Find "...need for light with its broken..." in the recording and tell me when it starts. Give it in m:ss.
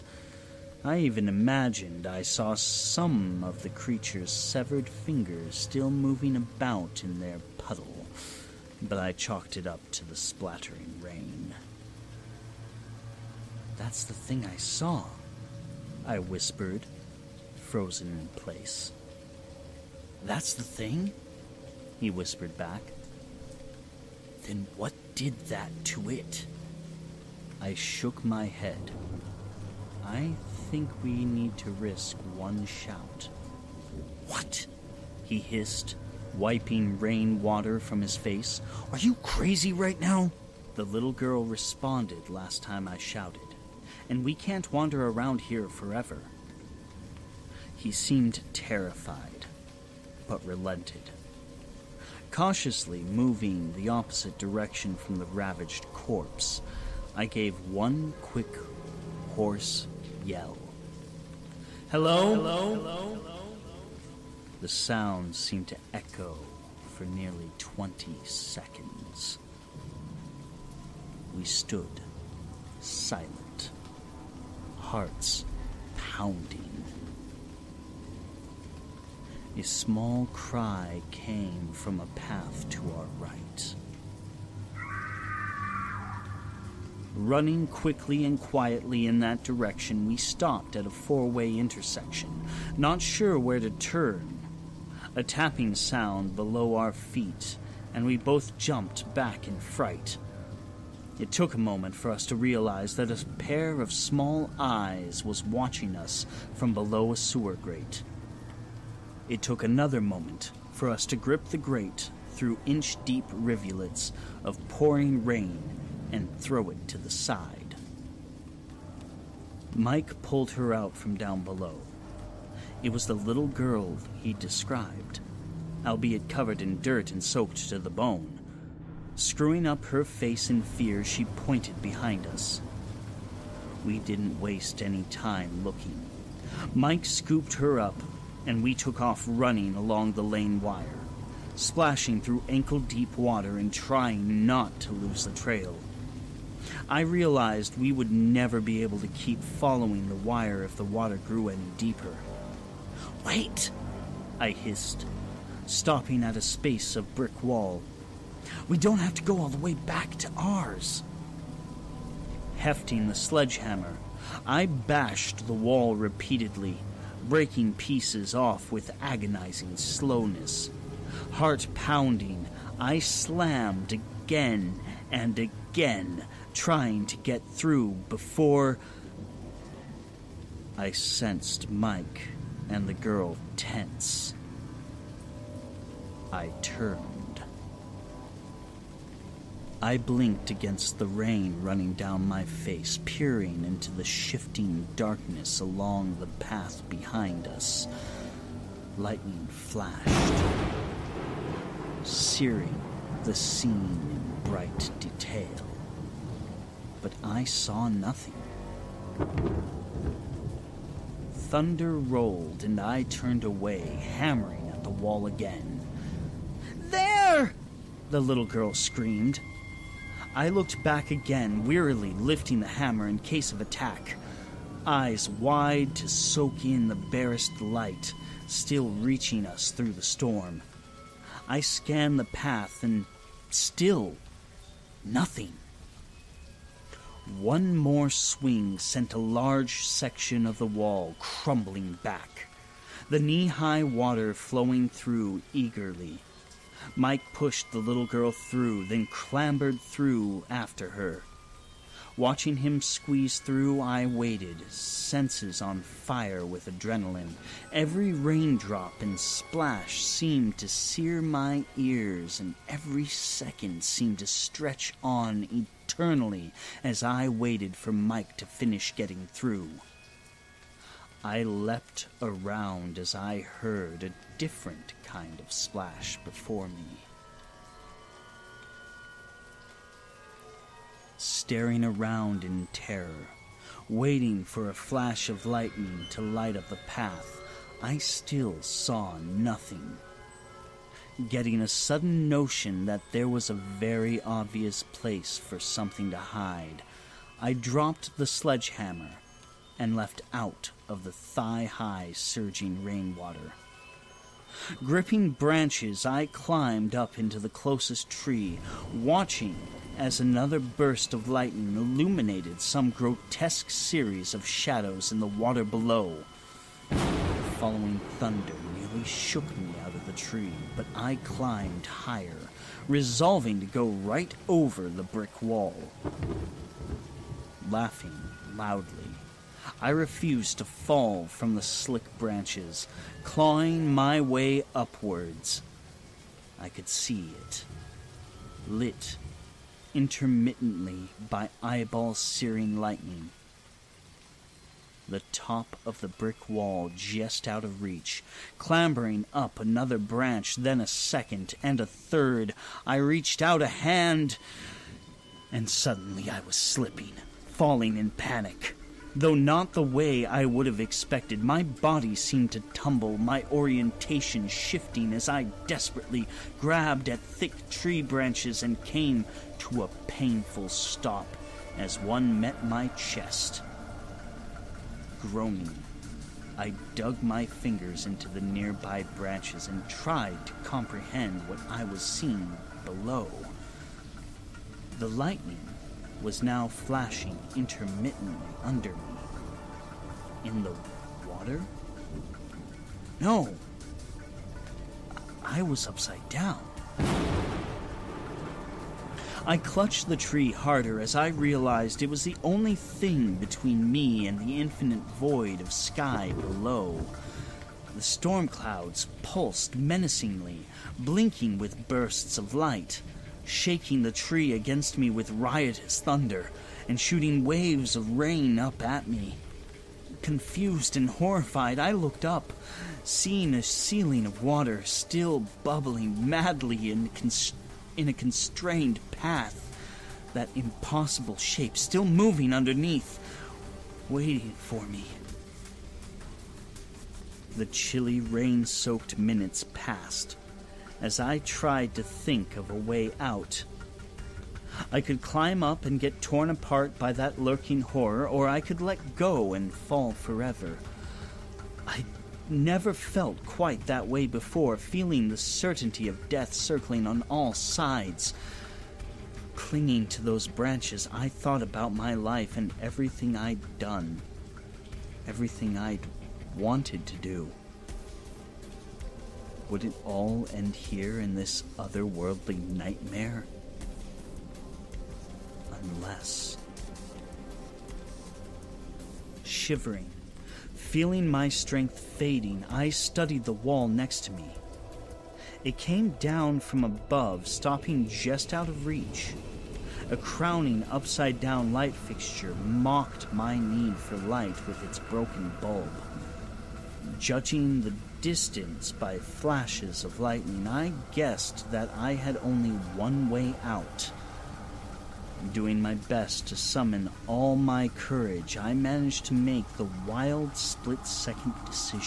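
8:13.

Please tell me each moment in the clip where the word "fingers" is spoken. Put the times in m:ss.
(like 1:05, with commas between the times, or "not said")
0:04, 6:17.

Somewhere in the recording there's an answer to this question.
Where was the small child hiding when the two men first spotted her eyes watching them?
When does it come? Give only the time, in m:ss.
1:46.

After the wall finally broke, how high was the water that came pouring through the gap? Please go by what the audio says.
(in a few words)
Knee high.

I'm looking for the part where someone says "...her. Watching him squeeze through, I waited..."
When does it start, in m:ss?
4:10.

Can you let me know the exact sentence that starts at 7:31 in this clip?
I never felt quite that way before, feeling the certainty of death circling on all sides.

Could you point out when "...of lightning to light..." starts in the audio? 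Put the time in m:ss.
4:45.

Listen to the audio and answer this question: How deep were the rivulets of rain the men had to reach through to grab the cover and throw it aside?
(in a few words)
Inch deep.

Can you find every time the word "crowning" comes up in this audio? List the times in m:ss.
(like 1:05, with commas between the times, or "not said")
8:10.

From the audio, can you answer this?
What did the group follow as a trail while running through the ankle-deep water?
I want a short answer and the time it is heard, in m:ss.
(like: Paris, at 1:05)
The lane wire, at 2:20.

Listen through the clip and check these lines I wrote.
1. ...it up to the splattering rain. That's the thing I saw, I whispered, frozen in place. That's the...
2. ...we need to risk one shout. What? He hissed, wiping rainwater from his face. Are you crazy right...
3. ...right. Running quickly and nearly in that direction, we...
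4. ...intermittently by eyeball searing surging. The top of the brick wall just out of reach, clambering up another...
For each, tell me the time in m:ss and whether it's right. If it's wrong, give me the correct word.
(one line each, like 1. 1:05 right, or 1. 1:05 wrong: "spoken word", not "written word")
1. 0:09 right
2. 0:31 right
3. 1:23 wrong: "quietly", not "nearly"
4. 5:39 wrong: "lightning", not "surging".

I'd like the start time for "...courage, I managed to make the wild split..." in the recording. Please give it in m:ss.
8:27.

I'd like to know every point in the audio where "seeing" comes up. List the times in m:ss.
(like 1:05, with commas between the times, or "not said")
6:22, 7:03.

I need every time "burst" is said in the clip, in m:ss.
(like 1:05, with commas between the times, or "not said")
5:10, 6:51.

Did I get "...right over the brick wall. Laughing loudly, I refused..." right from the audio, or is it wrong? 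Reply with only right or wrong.
right.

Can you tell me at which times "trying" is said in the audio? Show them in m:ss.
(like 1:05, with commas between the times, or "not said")
2:23, 2:56.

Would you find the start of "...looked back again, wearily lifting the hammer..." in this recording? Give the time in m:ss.
3:40.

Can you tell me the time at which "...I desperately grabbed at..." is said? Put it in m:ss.
6:05.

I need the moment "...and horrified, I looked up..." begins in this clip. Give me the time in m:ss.
7:00.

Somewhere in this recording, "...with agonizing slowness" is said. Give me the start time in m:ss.
2:48.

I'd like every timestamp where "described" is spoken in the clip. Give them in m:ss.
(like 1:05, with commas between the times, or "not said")
2:04.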